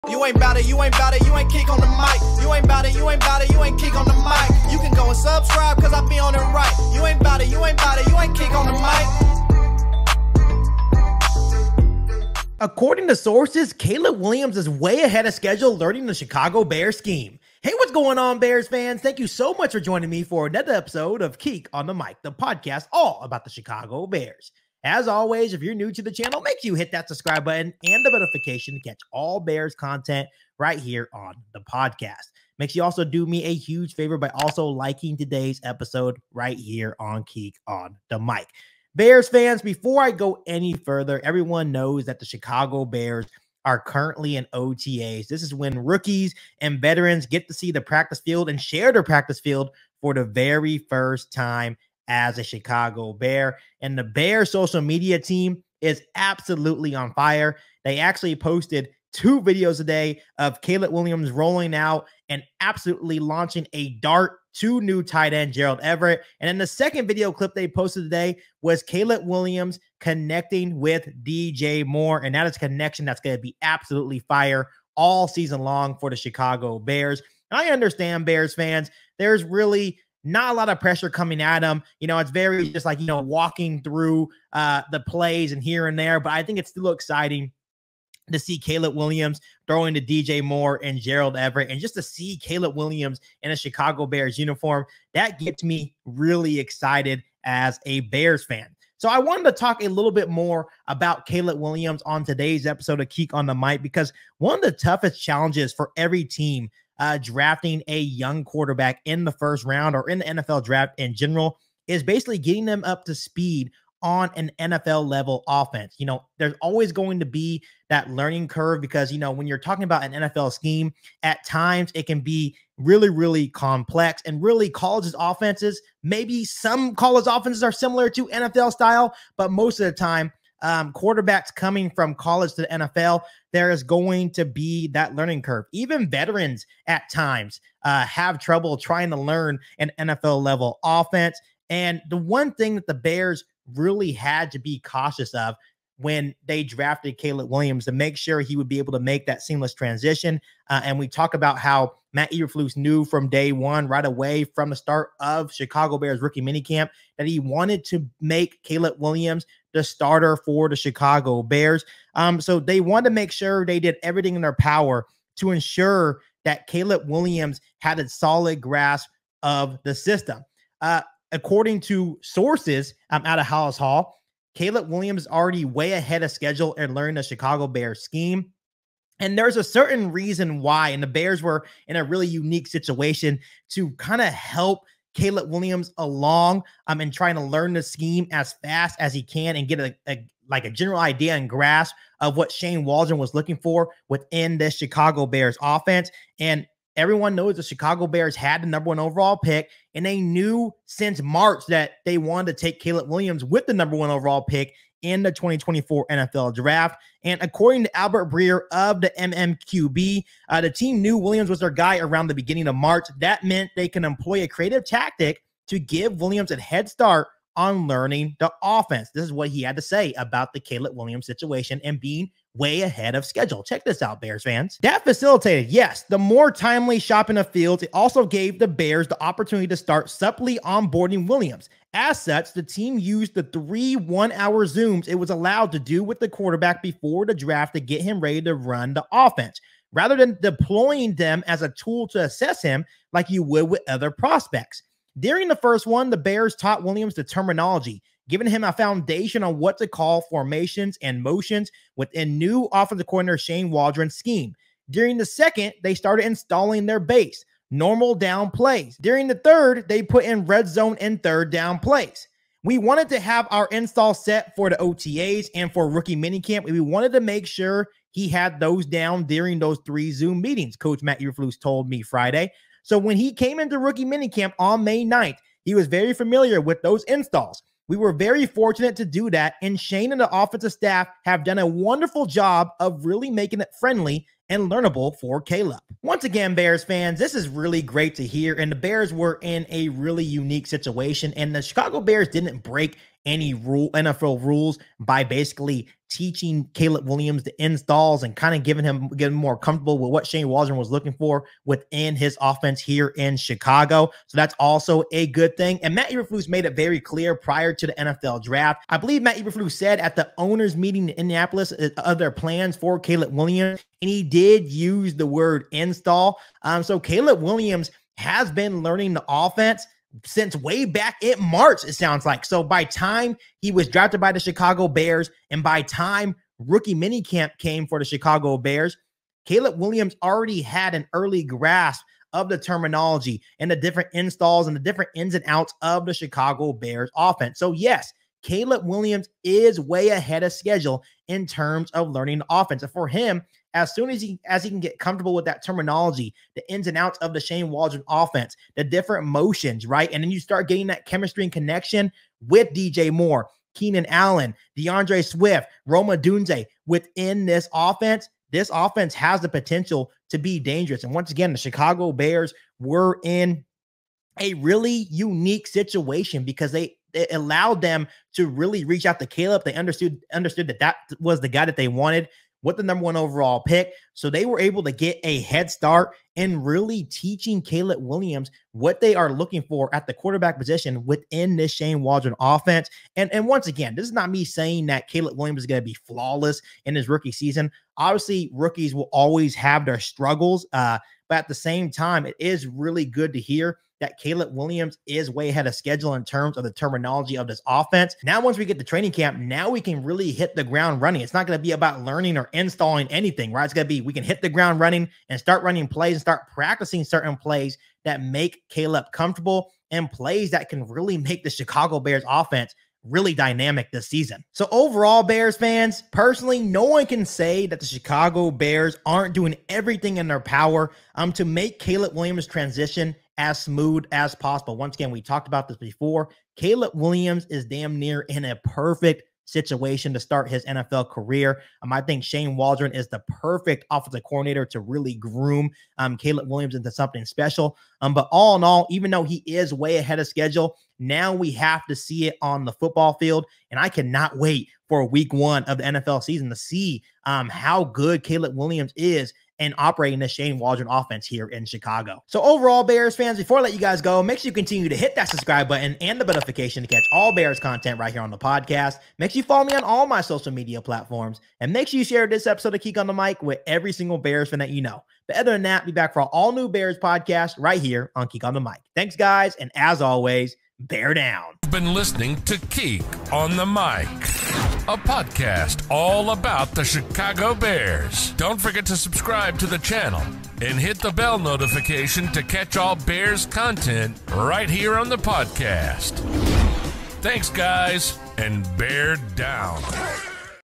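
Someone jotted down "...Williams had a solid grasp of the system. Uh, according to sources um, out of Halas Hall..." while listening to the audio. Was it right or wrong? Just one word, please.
right.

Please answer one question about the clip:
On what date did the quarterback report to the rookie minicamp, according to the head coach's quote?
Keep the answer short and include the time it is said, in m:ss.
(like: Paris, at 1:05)
May 9th, at 4:34.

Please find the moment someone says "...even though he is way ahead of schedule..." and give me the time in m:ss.
7:18.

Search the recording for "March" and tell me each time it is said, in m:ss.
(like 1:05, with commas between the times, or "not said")
3:21, 3:32, 5:21.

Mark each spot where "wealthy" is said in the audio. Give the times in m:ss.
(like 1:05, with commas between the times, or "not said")
not said.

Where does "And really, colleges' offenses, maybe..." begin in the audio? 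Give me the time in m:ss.
2:04.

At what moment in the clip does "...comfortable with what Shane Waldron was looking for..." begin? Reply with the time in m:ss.
4:59.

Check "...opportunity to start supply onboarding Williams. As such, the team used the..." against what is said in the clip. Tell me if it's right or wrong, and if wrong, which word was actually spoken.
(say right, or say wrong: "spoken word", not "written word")
right.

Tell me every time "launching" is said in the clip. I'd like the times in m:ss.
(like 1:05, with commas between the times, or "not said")
1:03.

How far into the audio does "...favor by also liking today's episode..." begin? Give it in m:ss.
0:33.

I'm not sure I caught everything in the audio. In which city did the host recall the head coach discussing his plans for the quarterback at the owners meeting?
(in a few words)
Indianapolis.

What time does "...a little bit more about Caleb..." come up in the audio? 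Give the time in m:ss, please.
1:39.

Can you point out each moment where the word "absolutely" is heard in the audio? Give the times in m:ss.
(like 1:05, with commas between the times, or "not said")
0:56, 1:02, 1:13.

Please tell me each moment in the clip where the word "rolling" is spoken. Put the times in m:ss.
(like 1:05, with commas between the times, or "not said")
1:01.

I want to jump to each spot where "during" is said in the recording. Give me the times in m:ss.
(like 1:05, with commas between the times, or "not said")
4:05, 4:14, 4:19, 4:29.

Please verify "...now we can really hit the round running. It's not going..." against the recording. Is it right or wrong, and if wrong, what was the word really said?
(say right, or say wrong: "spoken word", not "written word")
wrong: "ground", not "round".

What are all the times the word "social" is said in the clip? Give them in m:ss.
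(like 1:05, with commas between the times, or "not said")
0:54, 7:40.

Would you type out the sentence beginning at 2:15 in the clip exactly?
Even veterans at times uh, have trouble trying to learn an NFL level offense.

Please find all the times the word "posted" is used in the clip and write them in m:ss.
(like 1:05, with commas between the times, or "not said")
0:58, 1:07.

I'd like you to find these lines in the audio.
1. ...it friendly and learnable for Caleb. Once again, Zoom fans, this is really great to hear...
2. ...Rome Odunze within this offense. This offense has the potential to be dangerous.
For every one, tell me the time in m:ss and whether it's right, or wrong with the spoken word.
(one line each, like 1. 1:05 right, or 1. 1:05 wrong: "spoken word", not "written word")
1. 4:43 wrong: "Bears", not "Zoom"
2. 5:55 right.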